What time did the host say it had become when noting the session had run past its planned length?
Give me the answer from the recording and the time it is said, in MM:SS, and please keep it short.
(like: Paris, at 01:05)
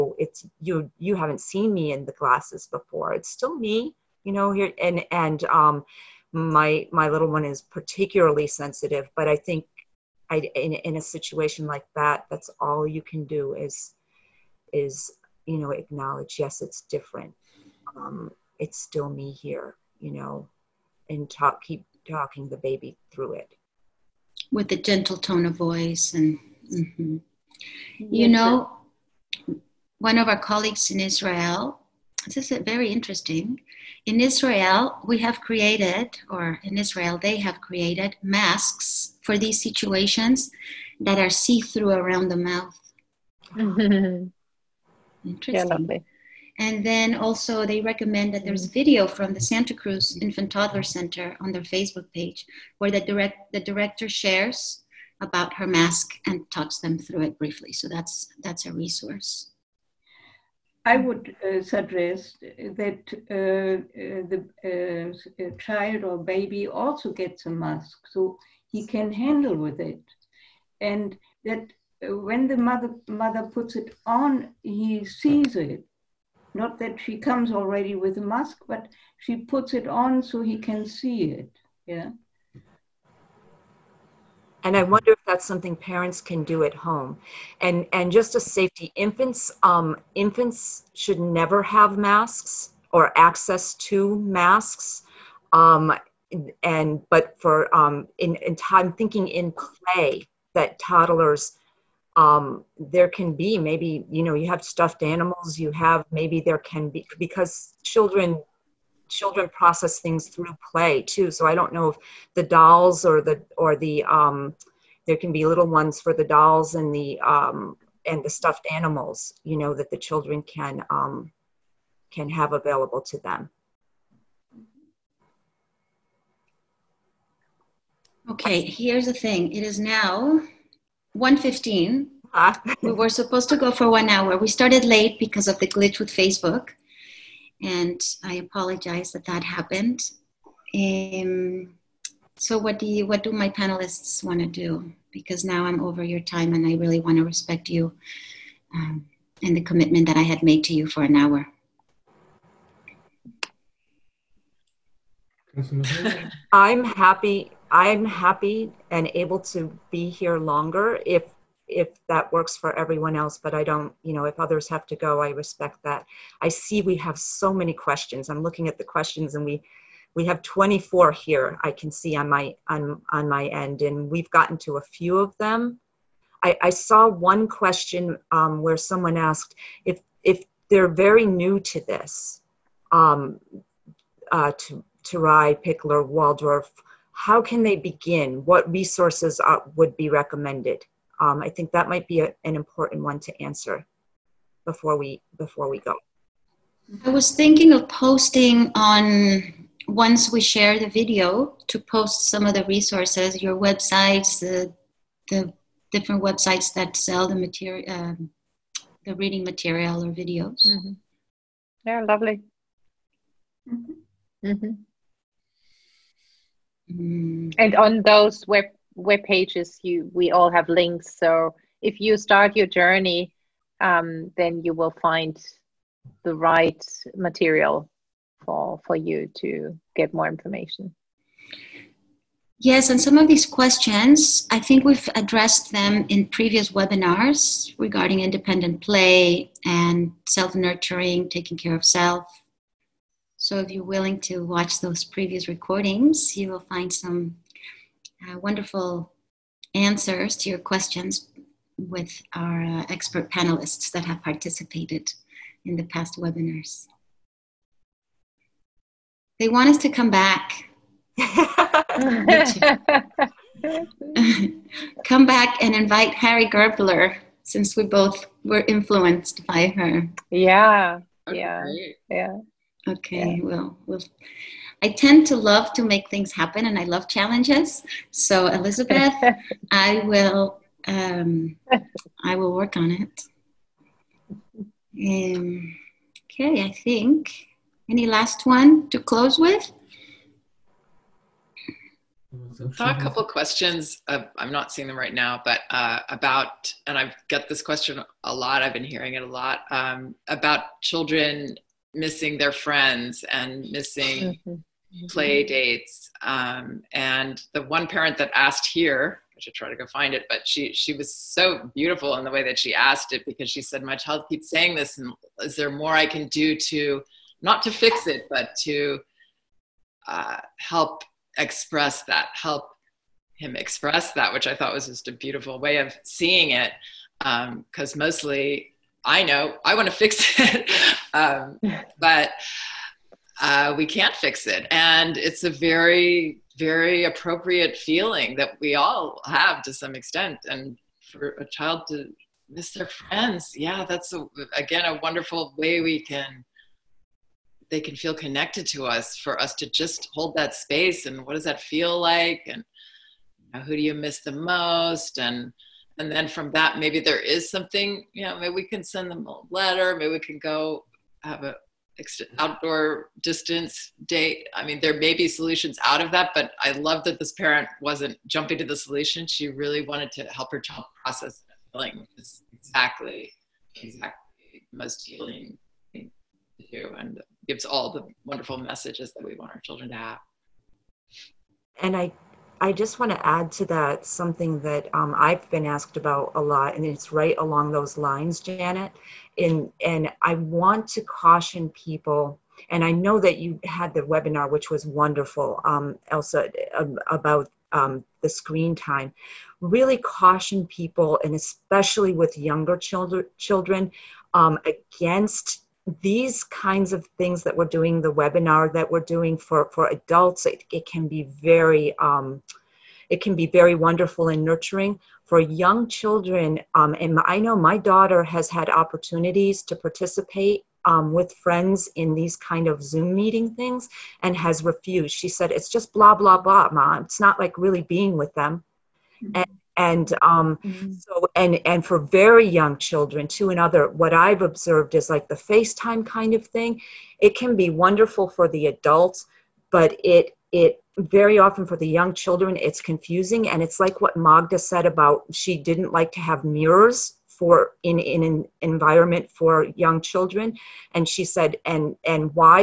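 1:15, at 02:11.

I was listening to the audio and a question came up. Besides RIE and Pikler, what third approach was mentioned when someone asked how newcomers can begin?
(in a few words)
Waldorf.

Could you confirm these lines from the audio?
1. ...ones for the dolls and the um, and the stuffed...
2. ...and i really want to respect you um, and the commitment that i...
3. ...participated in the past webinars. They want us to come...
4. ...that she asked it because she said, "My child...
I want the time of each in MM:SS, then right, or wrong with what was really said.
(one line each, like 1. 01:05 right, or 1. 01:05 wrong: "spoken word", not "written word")
1. 01:55 right
2. 02:26 right
3. 04:14 right
4. 05:12 right.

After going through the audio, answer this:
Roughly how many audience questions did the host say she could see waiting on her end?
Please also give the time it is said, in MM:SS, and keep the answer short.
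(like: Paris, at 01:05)
24, at 02:50.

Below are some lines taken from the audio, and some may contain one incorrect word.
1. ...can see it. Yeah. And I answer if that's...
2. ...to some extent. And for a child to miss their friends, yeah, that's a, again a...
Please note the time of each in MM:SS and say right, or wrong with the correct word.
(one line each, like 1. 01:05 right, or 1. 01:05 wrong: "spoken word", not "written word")
1. 01:20 wrong: "wonder", not "answer"
2. 05:39 right.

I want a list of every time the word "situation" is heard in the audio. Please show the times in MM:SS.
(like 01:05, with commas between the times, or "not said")
00:11, 00:39.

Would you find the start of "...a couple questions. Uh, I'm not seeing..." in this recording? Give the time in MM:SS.
04:52.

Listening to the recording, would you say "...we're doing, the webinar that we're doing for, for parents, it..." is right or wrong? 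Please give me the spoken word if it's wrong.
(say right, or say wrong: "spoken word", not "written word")
wrong: "adults", not "parents".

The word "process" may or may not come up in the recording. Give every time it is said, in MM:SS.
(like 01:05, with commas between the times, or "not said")
01:49, 06:11.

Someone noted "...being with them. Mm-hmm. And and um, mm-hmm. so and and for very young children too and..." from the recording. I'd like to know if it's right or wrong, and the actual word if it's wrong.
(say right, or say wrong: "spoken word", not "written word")
right.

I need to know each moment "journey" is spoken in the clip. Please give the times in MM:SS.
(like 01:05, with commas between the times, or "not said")
03:42.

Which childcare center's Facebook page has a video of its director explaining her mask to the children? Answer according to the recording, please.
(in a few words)
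Santa Cruz Infant Toddler Center.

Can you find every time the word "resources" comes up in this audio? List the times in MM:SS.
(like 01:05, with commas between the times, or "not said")
00:58, 03:08, 03:22.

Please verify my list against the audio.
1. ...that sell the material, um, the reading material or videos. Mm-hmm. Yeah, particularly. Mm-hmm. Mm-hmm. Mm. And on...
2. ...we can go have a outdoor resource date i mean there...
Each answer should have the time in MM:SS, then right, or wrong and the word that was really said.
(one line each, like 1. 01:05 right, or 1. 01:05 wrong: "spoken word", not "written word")
1. 03:26 wrong: "lovely", not "particularly"
2. 06:00 wrong: "distance", not "resource".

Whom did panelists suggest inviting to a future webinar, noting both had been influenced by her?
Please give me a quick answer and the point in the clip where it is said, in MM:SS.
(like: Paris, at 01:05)
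Harry Gerbler, at 04:26.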